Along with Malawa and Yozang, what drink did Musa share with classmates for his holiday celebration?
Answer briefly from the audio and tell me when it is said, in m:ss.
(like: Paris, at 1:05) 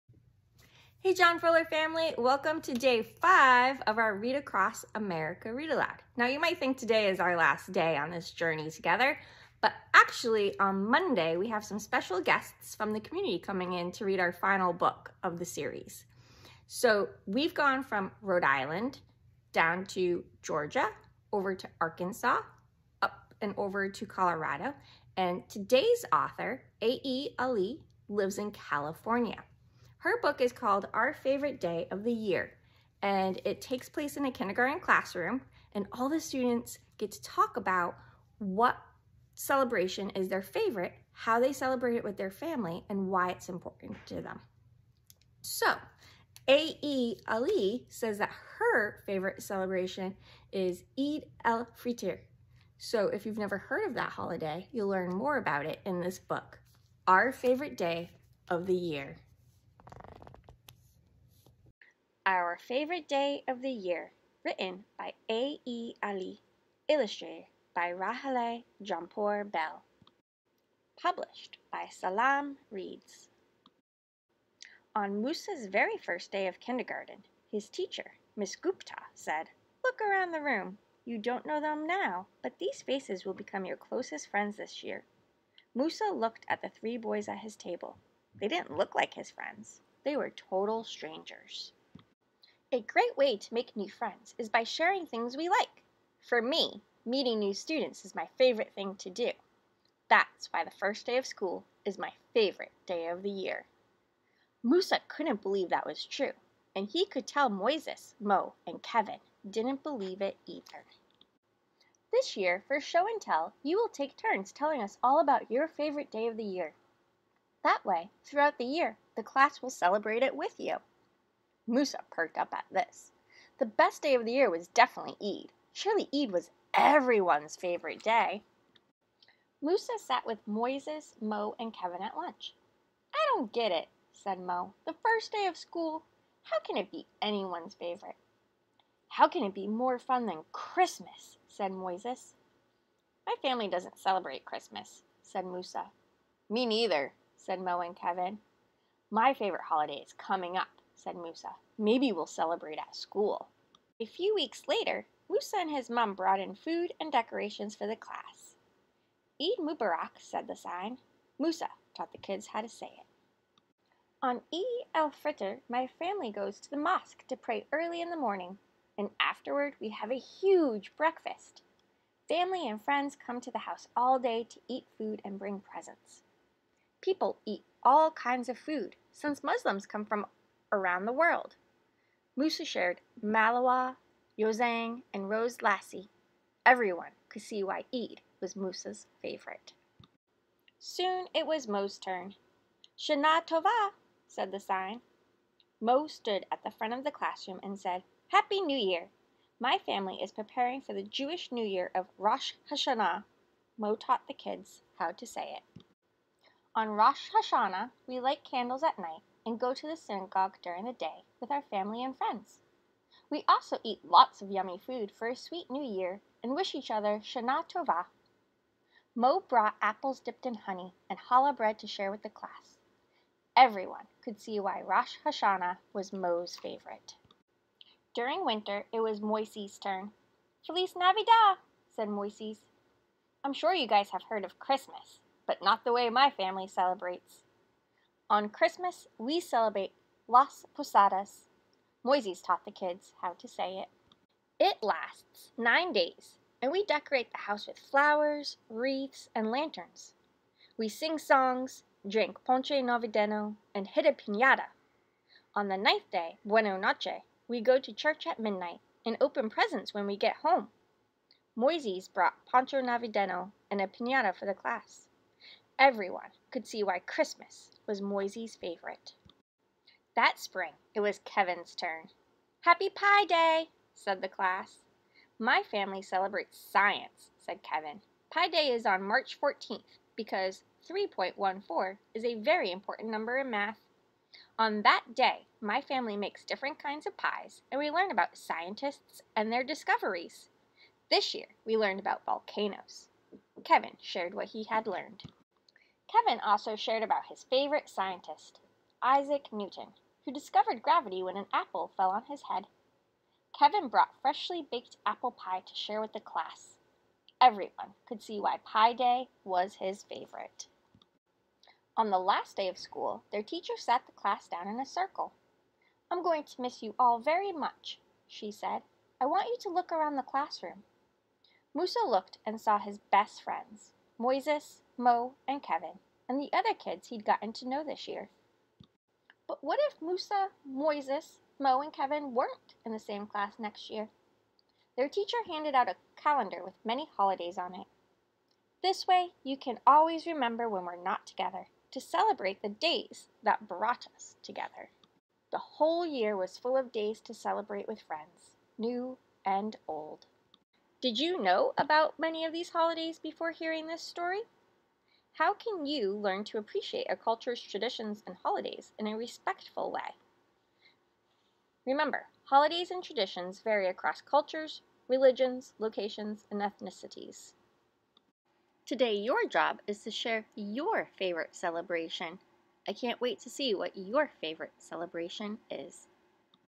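Rose lassi, at 3:05.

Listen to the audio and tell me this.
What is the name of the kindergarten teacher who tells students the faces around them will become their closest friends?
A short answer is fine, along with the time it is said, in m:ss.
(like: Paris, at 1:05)
Miss Gupta, at 1:18.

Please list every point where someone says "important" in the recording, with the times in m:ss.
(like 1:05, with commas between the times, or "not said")
0:43, 4:42.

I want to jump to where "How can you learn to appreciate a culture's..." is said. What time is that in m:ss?
5:55.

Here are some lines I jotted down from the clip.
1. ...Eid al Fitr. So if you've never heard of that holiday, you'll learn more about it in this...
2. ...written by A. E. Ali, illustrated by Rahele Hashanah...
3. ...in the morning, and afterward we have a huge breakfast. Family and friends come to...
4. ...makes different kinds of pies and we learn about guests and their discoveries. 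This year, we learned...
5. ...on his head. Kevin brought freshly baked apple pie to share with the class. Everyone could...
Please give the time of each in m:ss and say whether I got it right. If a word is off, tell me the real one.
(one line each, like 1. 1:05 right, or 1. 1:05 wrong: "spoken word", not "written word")
1. 0:50 right
2. 1:04 wrong: "Jomepour", not "Hashanah"
3. 2:48 right
4. 4:46 wrong: "scientists", not "guests"
5. 5:02 right.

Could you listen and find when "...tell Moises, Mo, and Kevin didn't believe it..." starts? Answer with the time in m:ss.
1:47.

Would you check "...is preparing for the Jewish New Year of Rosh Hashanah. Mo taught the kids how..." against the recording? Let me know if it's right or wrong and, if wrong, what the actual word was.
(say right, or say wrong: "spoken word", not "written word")
right.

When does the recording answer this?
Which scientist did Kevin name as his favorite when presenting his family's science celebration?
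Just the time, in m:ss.
4:59.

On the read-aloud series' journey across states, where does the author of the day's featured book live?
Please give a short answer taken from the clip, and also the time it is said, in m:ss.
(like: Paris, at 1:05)
California, at 0:28.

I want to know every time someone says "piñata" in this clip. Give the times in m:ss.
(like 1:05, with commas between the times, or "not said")
4:14, 4:23.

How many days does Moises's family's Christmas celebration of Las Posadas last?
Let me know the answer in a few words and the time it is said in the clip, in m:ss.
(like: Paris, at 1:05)
9, at 4:05.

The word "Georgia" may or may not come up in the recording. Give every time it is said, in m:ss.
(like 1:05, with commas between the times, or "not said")
0:20.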